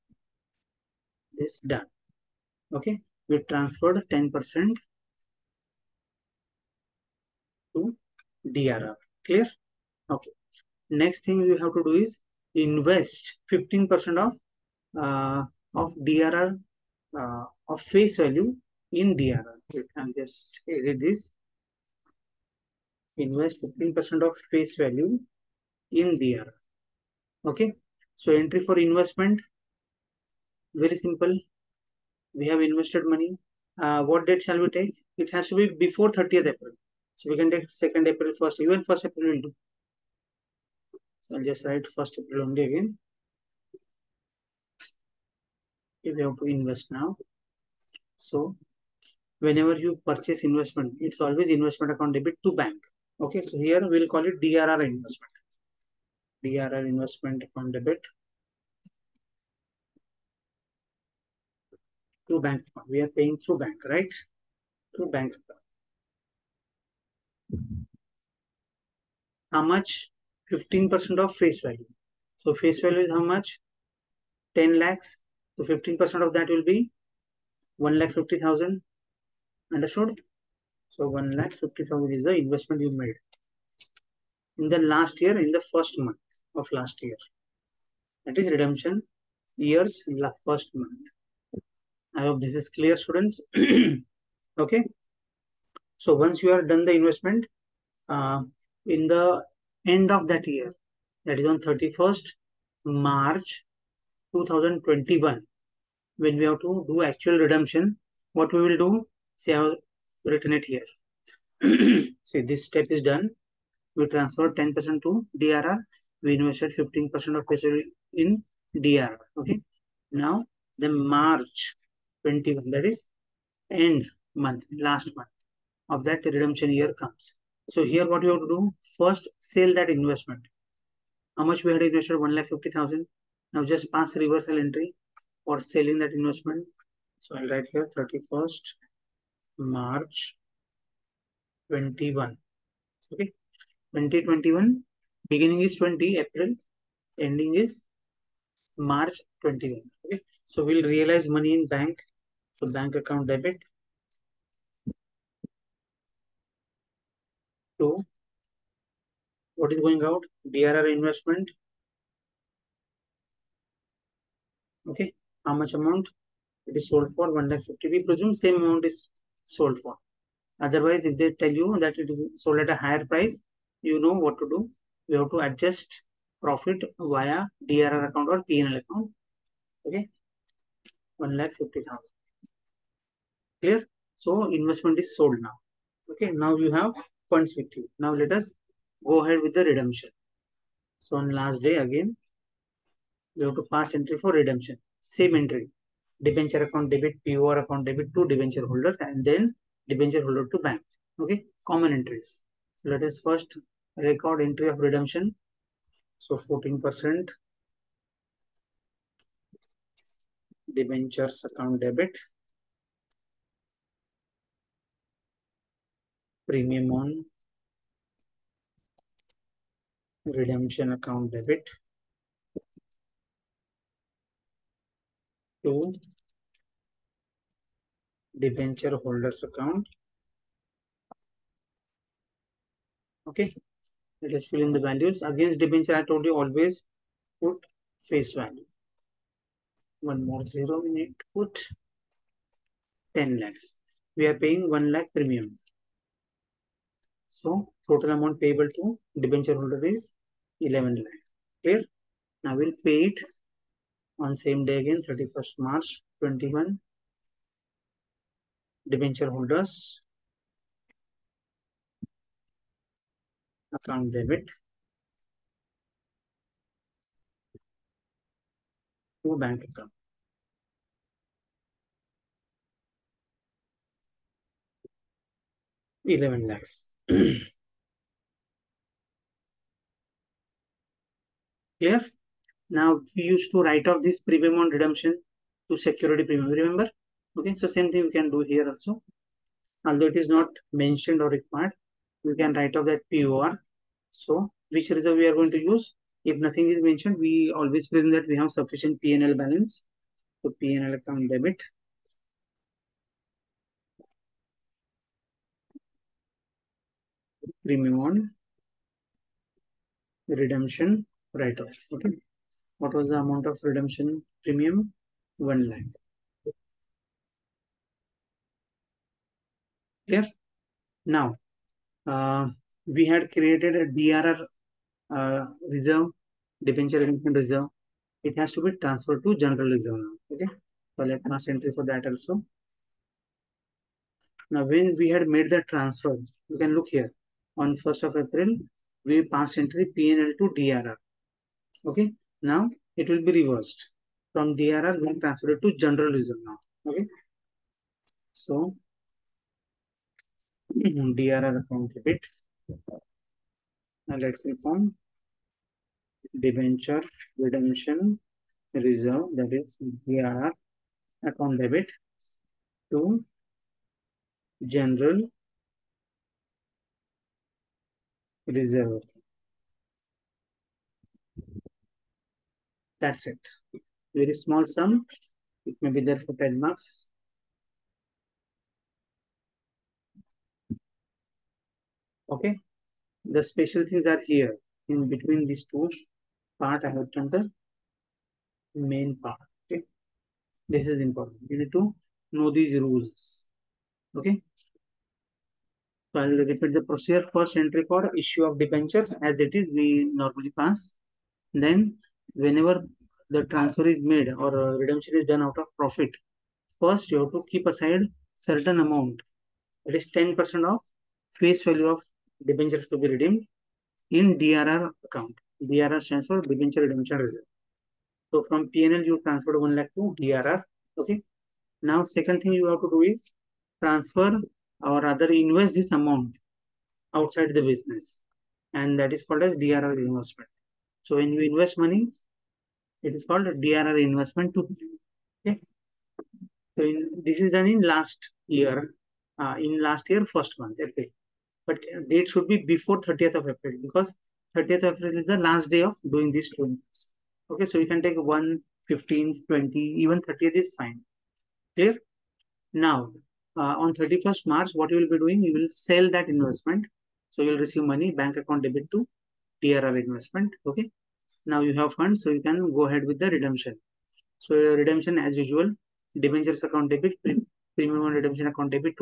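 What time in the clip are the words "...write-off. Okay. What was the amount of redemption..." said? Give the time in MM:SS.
05:11.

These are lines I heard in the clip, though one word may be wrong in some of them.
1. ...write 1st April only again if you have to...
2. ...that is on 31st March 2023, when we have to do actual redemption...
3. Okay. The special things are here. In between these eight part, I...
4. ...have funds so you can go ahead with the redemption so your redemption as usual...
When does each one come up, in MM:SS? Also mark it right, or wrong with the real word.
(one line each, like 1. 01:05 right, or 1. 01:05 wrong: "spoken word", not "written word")
1. 00:41 right
2. 01:41 wrong: "2021", not "2023"
3. 06:22 wrong: "two", not "eight"
4. 07:41 right.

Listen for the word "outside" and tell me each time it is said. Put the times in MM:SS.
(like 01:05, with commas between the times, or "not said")
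07:07.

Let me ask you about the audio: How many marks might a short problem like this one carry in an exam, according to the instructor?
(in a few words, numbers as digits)
10 marks.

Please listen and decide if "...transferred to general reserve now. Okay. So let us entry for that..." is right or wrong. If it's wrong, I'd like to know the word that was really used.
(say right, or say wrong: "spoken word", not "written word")
right.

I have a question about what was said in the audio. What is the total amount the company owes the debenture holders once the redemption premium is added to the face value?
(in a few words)
11 lakhs.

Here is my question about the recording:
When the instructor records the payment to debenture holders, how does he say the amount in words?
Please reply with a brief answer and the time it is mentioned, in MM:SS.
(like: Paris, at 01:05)
eleven lakhs, at 04:36.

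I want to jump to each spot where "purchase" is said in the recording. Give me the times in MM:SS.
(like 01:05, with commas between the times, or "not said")
00:50.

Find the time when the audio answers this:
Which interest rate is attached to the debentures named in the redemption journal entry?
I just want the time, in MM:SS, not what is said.
03:26.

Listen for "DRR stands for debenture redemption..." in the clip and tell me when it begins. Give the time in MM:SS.
06:55.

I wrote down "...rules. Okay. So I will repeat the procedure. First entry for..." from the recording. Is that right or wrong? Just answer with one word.
right.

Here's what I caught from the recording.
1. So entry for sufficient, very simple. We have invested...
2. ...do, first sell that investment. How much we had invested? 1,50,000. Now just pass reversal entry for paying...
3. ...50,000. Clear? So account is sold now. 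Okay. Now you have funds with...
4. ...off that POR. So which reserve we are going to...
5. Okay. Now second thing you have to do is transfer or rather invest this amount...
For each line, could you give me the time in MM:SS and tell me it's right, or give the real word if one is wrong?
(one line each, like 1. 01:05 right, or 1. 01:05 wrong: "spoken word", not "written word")
1. 00:28 wrong: "investment", not "sufficient"
2. 02:08 wrong: "selling", not "paying"
3. 03:01 wrong: "investment", not "account"
4. 04:52 right
5. 07:00 right.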